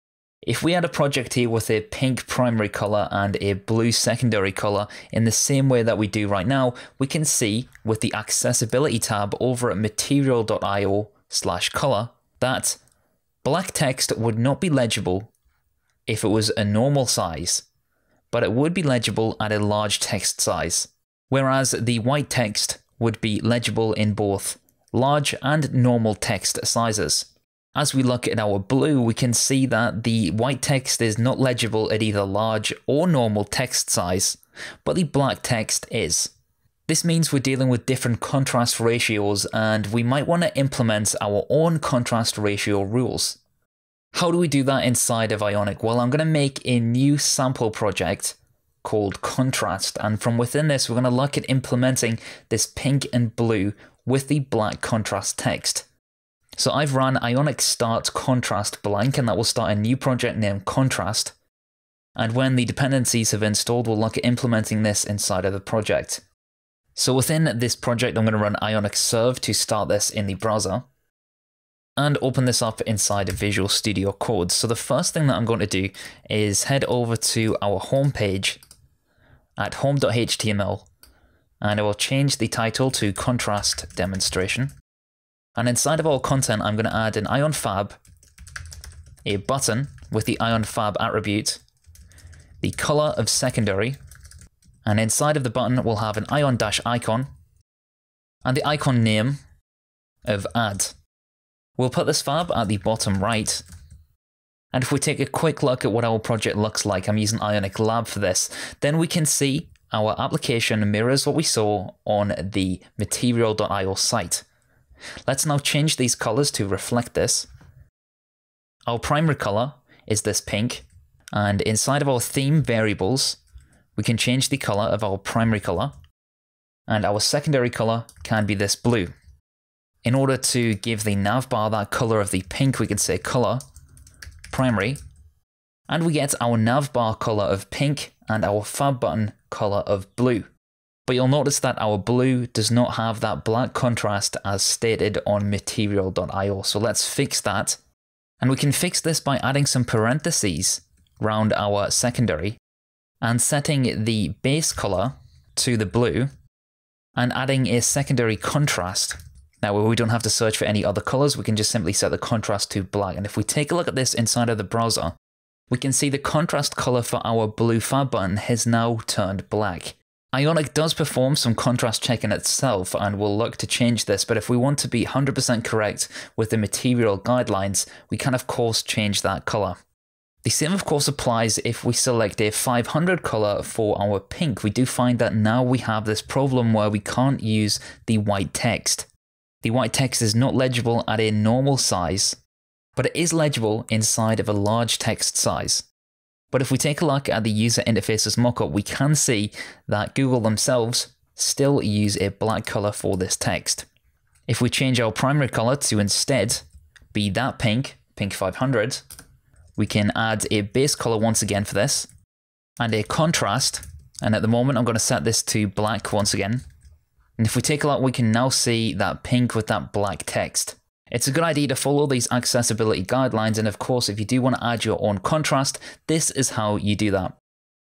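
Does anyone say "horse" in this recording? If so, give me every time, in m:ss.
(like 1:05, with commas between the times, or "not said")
not said.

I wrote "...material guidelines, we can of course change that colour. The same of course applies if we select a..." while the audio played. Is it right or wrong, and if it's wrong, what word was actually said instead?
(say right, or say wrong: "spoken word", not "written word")
right.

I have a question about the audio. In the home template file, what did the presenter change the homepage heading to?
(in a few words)
Contrast Demonstration.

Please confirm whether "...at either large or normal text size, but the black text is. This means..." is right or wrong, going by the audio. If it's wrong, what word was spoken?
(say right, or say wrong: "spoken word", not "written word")
right.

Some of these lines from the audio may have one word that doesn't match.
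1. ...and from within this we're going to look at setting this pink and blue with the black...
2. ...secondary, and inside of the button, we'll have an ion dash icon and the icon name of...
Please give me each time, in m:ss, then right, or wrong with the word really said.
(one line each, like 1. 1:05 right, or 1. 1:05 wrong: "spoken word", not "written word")
1. 0:50 wrong: "implementing", not "setting"
2. 1:33 right.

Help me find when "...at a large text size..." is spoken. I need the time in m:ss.
0:19.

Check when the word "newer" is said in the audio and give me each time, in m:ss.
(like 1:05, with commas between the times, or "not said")
not said.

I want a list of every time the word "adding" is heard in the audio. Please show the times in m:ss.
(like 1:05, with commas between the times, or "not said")
2:29, 2:37.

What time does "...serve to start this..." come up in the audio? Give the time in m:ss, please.
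1:08.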